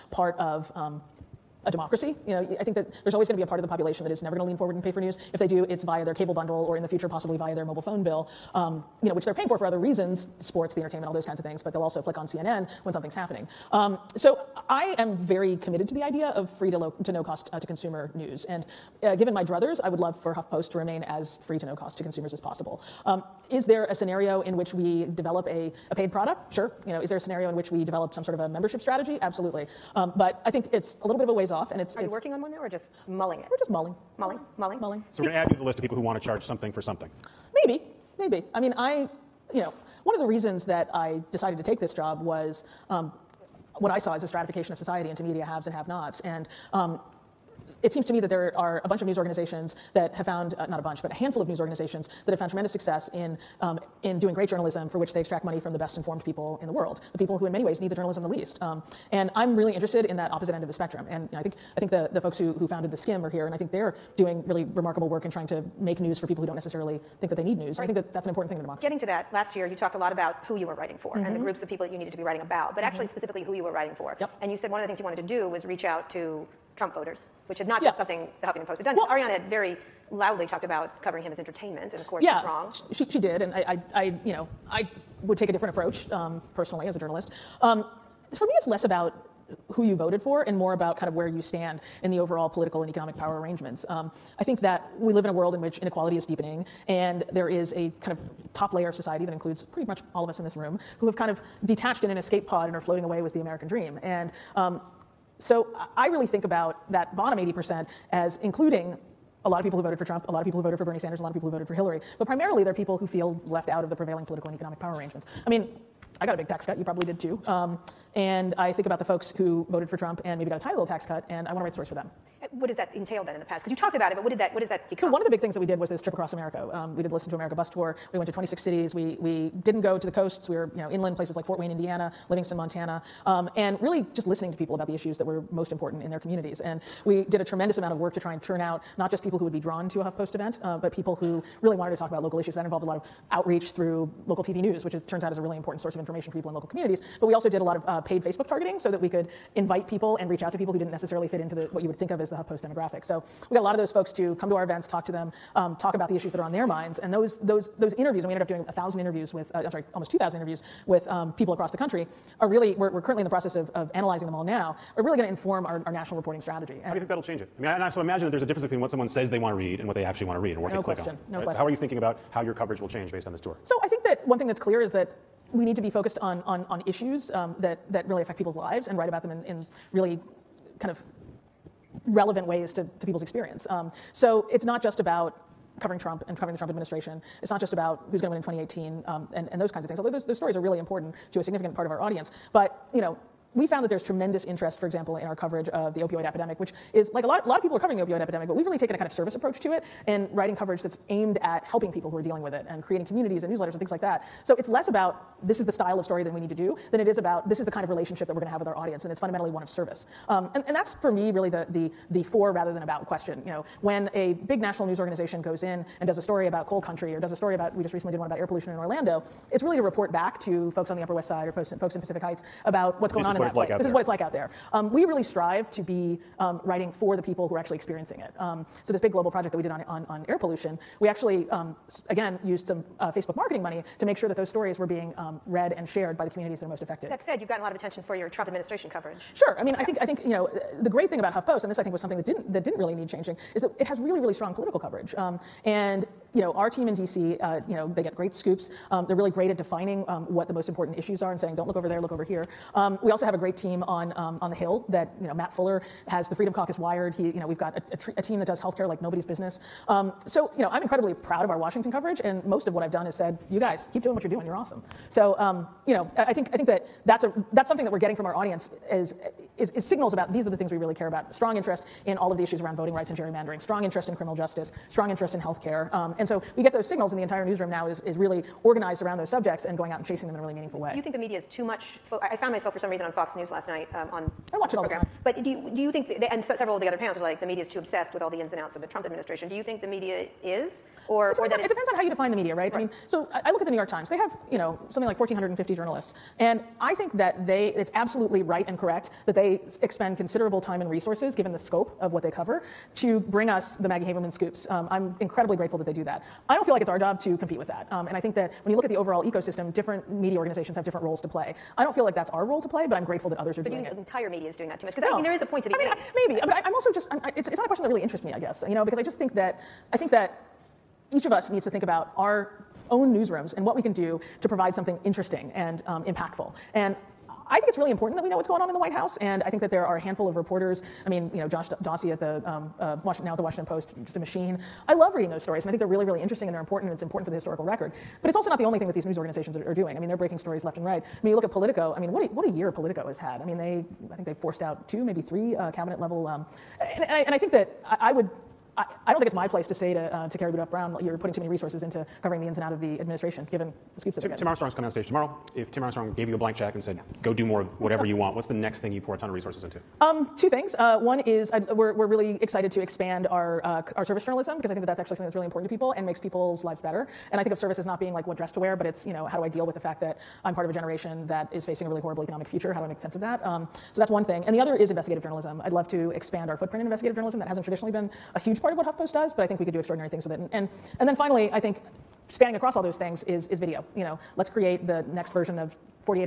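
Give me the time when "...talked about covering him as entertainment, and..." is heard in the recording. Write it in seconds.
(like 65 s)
80 s.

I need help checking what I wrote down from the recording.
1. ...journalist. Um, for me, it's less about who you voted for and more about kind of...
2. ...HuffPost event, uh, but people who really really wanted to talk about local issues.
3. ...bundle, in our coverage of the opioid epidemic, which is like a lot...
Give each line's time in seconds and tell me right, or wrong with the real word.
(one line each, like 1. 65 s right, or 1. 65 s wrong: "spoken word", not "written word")
1. 86 s right
2. 140 s right
3. 194 s wrong: "example", not "bundle".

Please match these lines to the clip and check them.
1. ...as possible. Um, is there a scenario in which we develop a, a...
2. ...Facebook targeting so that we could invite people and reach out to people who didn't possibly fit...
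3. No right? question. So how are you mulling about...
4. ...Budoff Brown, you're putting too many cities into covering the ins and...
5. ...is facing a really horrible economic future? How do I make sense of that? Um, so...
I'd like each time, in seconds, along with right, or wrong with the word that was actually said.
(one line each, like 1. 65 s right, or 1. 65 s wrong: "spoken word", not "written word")
1. 22 s right
2. 148 s wrong: "necessarily", not "possibly"
3. 171 s wrong: "thinking", not "mulling"
4. 350 s wrong: "resources", not "cities"
5. 371 s right.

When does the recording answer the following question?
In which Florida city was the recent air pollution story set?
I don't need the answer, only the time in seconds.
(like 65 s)
218 s.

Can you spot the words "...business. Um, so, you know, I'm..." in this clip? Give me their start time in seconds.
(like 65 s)
259 s.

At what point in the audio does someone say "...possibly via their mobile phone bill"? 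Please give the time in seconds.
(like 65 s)
7 s.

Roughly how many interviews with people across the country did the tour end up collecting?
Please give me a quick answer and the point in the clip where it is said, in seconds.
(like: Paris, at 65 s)
2,000, at 159 s.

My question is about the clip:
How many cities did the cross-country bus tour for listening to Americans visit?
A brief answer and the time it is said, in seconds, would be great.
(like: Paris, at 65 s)
26, at 128 s.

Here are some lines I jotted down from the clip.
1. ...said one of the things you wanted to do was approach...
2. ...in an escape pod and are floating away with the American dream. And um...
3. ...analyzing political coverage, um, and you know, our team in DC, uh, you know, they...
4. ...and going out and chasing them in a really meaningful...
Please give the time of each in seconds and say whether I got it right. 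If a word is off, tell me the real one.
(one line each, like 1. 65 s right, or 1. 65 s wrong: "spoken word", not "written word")
1. 74 s wrong: "reach", not "approach"
2. 102 s right
3. 244 s wrong: "strong", not "analyzing"
4. 279 s right.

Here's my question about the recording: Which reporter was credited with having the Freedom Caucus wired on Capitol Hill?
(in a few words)
Matt Fuller.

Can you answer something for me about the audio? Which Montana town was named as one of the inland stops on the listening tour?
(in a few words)
Livingston.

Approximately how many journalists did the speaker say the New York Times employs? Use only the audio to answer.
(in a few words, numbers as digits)
1,450.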